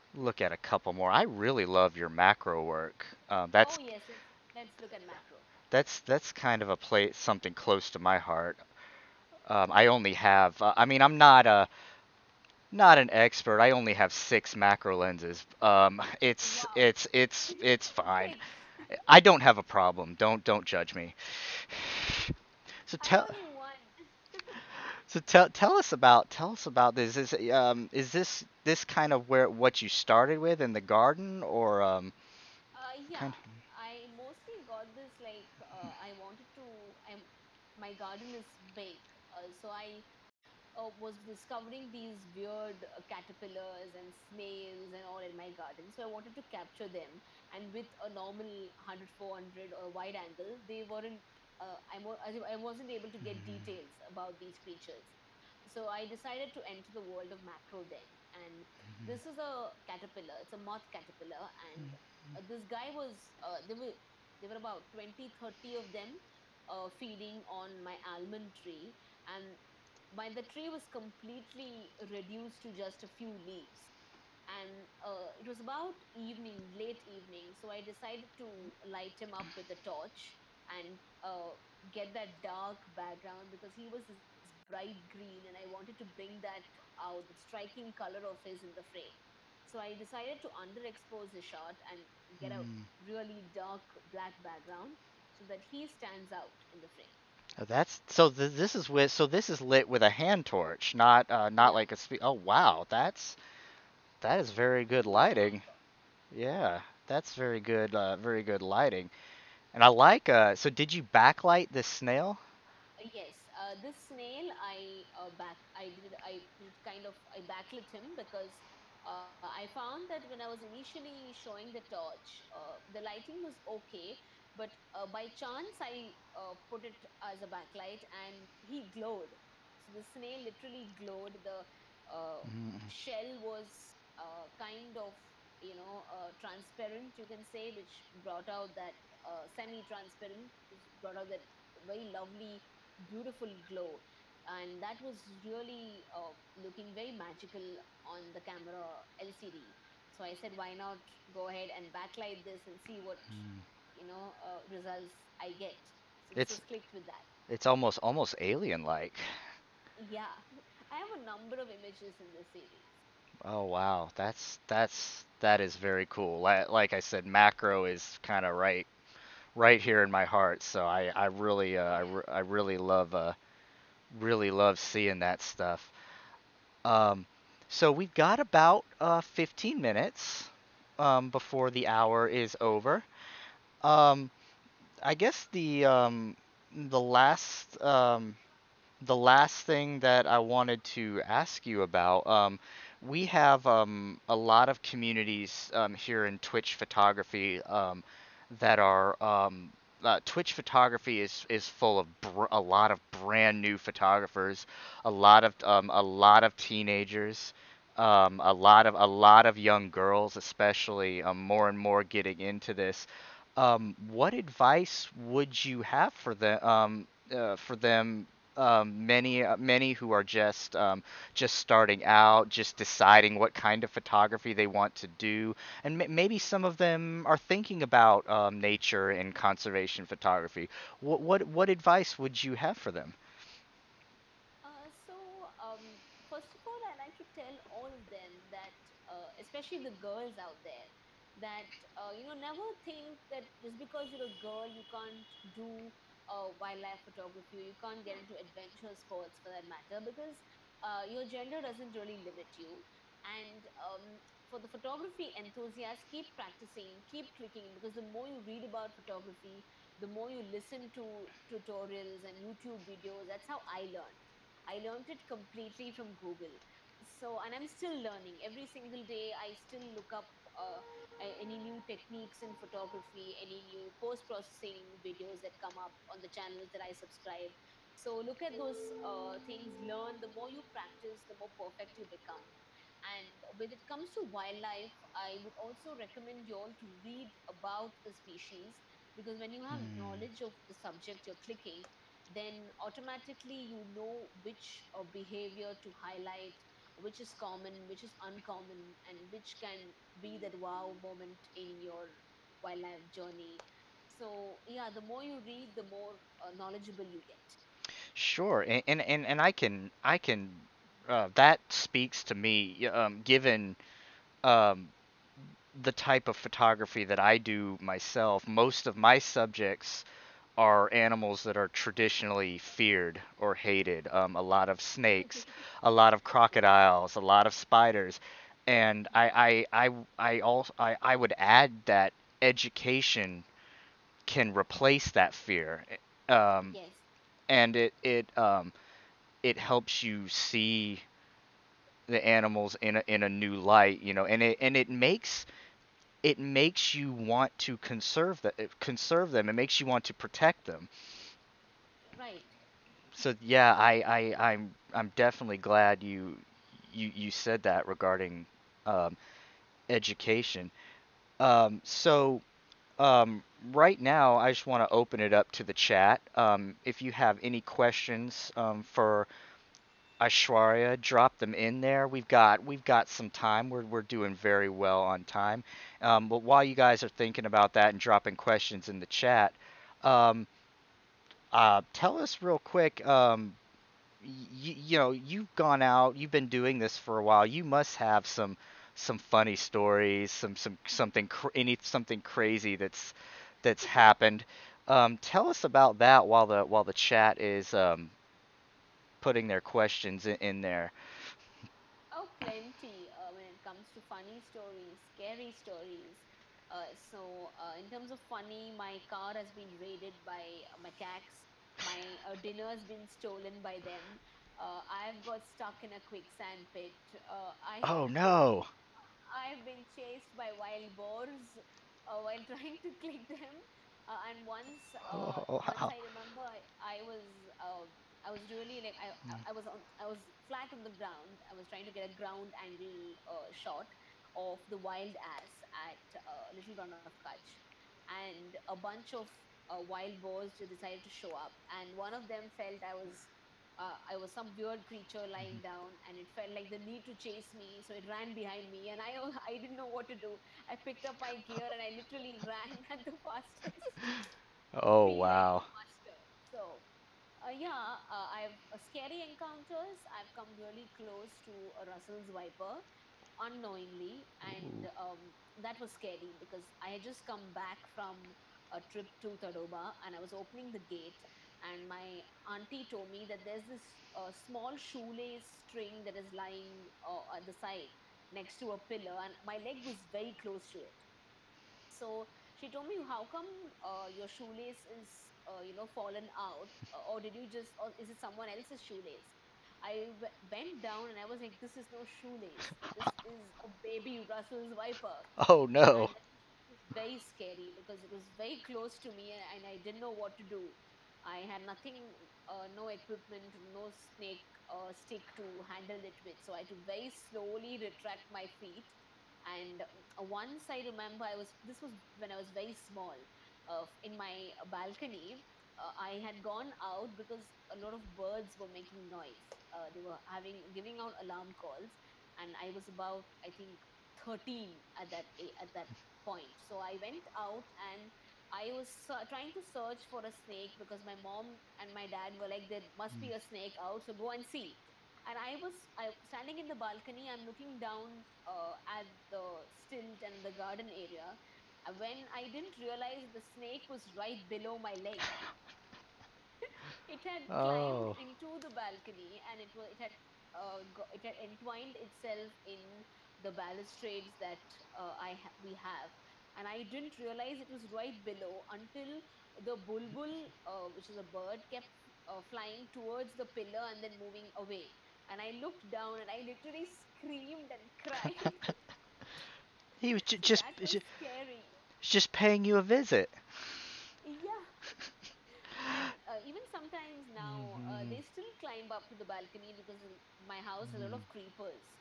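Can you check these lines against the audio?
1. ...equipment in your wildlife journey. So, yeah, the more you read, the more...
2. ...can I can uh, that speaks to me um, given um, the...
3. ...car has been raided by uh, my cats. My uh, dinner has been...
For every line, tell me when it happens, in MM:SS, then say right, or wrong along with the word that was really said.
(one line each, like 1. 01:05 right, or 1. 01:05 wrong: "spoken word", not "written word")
1. 05:01 wrong: "moment", not "equipment"
2. 05:09 right
3. 06:49 right.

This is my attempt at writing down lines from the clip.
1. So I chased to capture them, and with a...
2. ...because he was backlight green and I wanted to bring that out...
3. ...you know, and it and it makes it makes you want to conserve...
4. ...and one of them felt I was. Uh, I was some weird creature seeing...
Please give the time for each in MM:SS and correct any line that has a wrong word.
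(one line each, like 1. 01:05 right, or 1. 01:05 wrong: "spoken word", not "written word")
1. 00:45 wrong: "wanted", not "chased"
2. 01:23 wrong: "bright", not "backlight"
3. 05:44 right
4. 07:21 wrong: "lying", not "seeing".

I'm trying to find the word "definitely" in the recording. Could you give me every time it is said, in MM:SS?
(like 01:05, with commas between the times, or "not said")
05:55.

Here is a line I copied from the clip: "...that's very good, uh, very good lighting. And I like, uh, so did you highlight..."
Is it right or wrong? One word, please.
wrong.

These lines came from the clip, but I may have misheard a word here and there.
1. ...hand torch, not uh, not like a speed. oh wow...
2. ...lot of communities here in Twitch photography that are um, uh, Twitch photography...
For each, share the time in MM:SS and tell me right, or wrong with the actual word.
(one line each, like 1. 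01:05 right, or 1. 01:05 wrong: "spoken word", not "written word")
1. 01:40 right
2. 03:14 right.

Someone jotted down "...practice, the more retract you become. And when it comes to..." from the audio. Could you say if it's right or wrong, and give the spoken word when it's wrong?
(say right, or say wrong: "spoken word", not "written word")
wrong: "perfect", not "retract".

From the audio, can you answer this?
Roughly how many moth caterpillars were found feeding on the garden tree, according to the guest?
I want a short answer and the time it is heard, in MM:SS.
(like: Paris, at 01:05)
20 to 30, at 01:04.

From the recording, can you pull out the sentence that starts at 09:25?
And I looked down and I literally screamed and cried.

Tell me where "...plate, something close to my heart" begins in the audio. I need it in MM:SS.
00:06.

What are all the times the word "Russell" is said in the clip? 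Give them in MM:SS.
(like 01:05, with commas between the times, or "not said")
07:41, 08:14.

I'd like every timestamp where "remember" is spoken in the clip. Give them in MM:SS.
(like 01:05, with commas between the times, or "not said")
07:06, 08:30.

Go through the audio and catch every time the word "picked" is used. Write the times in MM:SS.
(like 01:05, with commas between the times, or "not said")
07:30.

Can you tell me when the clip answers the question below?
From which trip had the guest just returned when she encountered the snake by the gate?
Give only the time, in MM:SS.
07:49.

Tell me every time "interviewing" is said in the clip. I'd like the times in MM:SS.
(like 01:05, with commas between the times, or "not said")
not said.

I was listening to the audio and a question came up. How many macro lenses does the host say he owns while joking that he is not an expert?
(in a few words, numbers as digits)
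6.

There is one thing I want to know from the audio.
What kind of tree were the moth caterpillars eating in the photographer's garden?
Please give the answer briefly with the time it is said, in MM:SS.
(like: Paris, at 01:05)
Almond tree, at 01:08.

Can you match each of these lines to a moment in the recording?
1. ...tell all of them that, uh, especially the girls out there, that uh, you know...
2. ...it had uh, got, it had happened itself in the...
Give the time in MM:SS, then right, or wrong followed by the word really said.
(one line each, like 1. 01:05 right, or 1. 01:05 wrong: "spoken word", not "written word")
1. 03:57 right
2. 09:09 wrong: "entwined", not "happened".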